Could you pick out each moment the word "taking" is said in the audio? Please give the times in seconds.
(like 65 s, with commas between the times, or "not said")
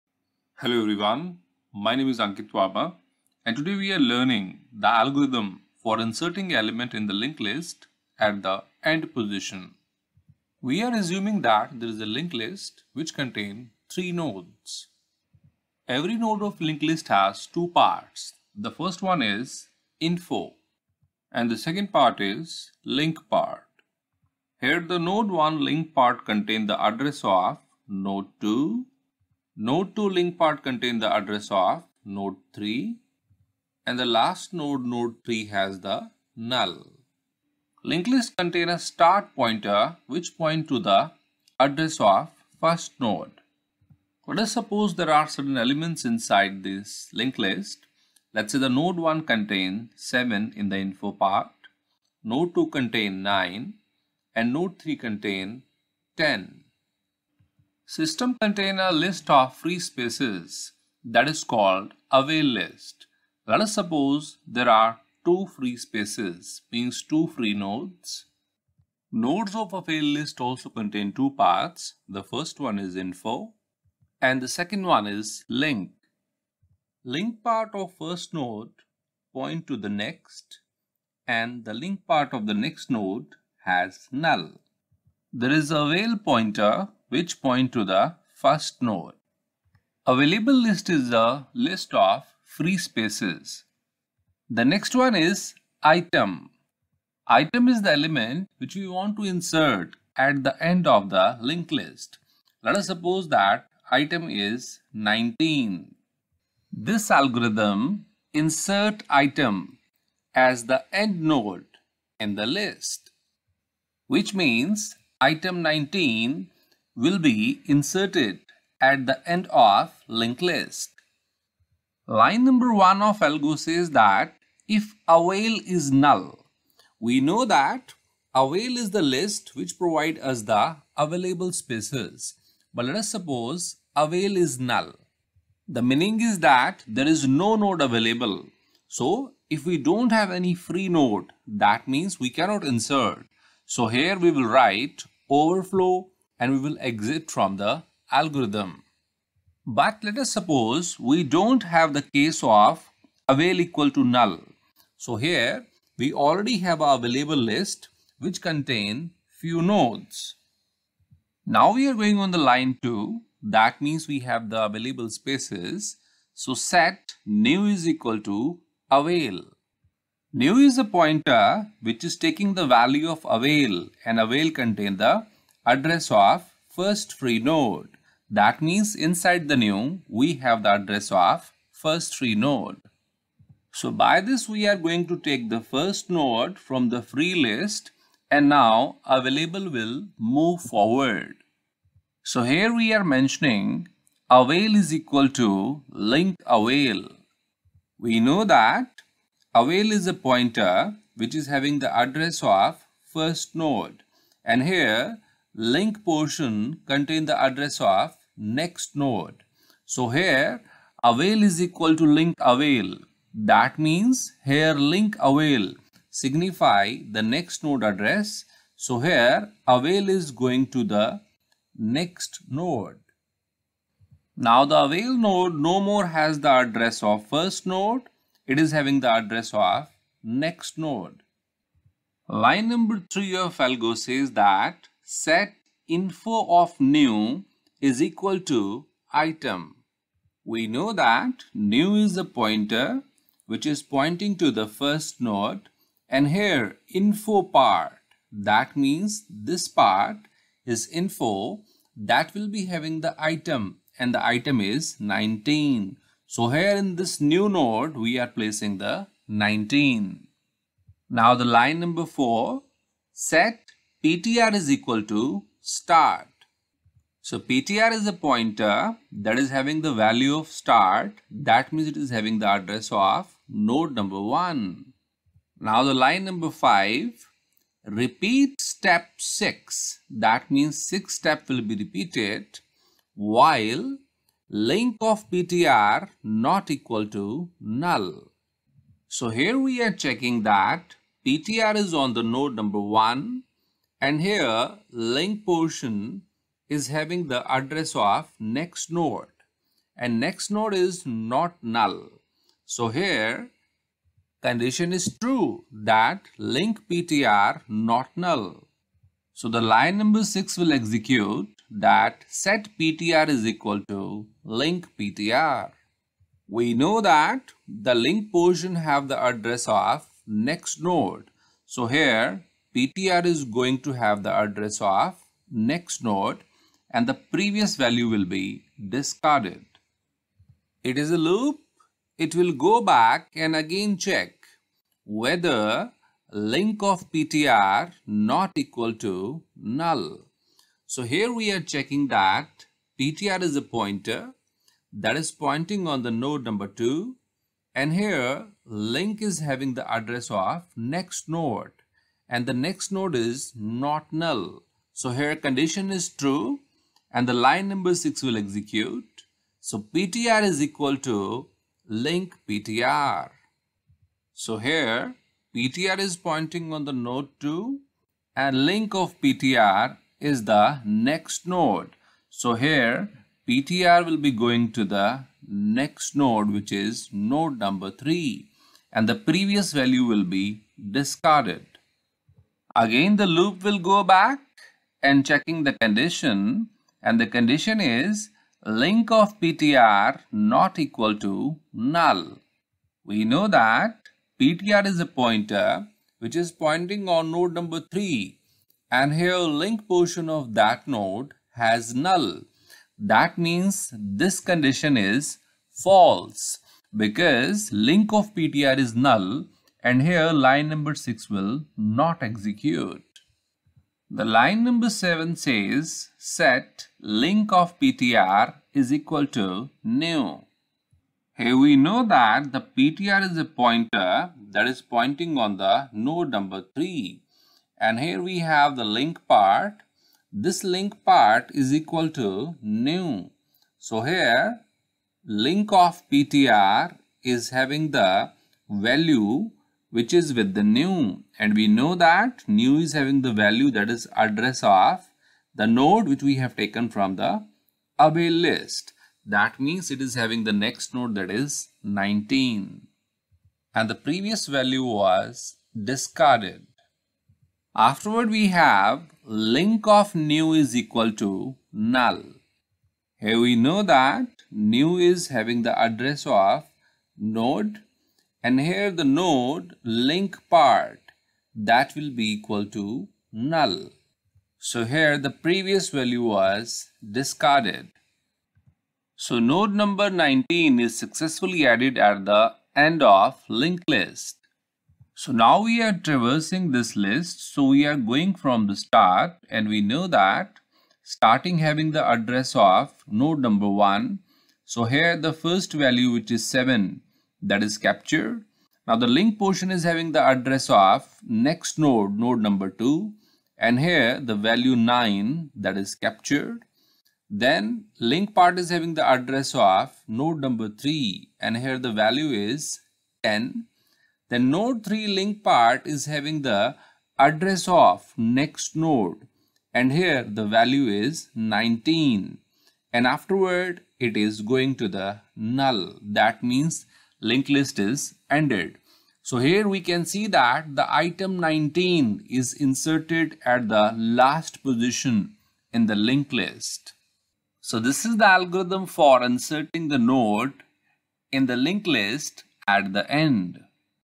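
172 s.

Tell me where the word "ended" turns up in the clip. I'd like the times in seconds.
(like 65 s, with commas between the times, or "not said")
528 s.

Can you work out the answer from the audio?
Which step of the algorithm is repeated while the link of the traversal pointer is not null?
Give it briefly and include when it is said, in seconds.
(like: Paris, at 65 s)
6, at 277 s.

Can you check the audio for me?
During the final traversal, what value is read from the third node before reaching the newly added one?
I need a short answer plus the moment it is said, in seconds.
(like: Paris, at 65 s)
10, at 511 s.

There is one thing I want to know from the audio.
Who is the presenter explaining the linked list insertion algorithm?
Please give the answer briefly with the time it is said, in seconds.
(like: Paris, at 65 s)
Ankit Verma, at 2 s.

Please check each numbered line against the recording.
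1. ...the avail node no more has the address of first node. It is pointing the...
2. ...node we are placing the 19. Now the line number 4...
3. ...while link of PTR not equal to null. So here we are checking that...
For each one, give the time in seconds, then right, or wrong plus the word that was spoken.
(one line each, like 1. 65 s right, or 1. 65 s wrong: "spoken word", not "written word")
1. 224 s wrong: "having", not "pointing"
2. 257 s right
3. 283 s right.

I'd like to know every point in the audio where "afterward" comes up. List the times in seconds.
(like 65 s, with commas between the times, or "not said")
457 s, 523 s.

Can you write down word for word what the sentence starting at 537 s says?
So this is the algorithm for inserting the node in the linked list at the end.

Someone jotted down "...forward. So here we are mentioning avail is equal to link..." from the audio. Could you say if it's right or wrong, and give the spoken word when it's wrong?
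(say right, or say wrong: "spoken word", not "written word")
right.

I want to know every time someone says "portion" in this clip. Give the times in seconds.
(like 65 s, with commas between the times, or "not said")
206 s, 295 s, 318 s, 399 s, 499 s.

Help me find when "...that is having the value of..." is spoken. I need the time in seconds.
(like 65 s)
269 s.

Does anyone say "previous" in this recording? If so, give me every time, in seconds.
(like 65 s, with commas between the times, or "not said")
327 s, 379 s, 453 s, 475 s.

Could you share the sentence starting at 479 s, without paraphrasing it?
So node number 19 is successfully added at the end of linked list.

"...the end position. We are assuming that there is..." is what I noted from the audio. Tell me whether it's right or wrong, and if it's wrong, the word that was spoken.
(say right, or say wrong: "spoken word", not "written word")
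right.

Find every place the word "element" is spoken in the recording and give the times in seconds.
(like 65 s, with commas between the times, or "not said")
6 s, 45 s, 97 s.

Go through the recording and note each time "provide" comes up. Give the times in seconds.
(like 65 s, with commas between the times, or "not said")
129 s.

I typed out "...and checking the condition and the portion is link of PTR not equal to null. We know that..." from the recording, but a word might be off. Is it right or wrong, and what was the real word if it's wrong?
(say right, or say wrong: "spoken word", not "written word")
wrong: "condition", not "portion".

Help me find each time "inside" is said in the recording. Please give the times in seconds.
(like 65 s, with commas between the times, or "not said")
46 s, 178 s.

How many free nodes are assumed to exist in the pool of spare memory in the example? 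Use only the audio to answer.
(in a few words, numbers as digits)
2.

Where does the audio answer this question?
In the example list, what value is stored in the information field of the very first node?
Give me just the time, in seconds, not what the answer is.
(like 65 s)
48 s.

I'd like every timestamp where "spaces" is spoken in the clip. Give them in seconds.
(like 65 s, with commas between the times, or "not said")
59 s, 65 s, 92 s, 131 s, 165 s.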